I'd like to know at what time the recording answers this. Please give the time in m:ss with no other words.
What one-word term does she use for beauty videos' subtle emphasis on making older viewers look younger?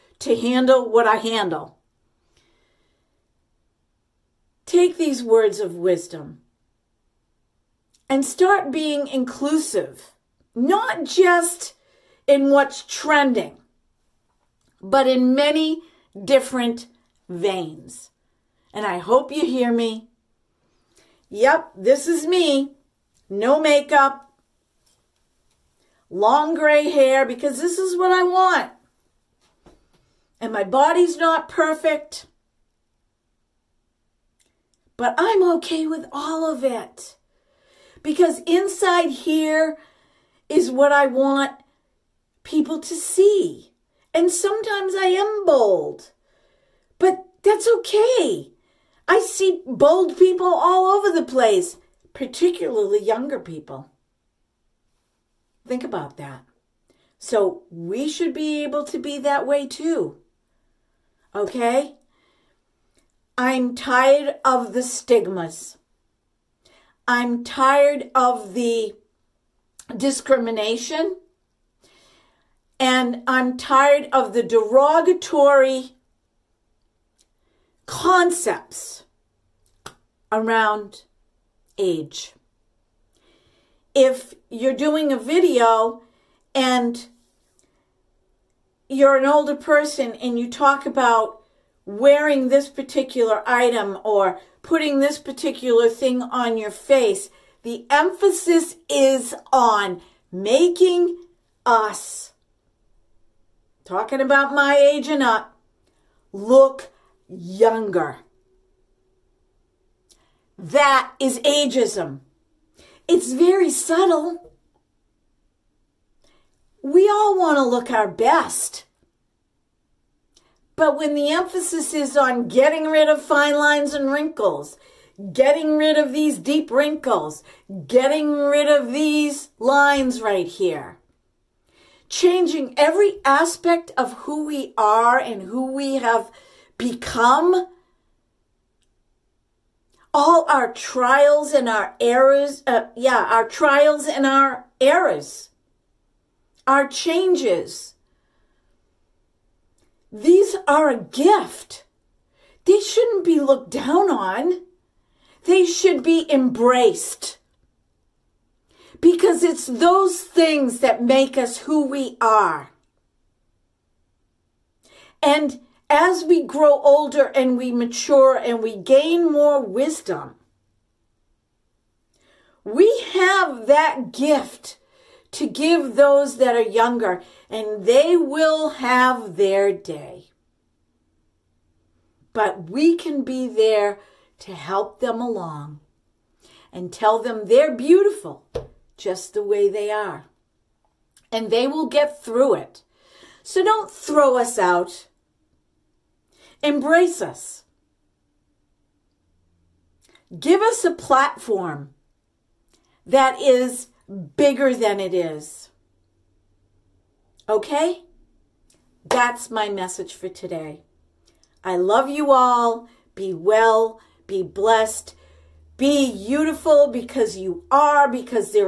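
1:51.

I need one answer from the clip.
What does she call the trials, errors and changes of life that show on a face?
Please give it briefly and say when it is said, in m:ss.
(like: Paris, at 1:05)
a gift, at 2:30.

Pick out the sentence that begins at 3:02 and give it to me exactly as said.
But we can be there to help them along and tell them they're beautiful just the way they are.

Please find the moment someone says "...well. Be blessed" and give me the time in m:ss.
3:33.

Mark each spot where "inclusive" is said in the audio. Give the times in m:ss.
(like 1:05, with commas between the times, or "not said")
0:09.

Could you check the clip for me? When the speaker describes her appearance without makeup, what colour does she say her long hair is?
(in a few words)
gray.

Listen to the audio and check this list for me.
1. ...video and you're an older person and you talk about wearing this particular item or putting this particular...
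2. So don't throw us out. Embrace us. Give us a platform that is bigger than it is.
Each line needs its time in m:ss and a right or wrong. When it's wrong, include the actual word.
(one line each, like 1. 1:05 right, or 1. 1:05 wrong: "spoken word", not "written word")
1. 1:25 right
2. 3:13 right.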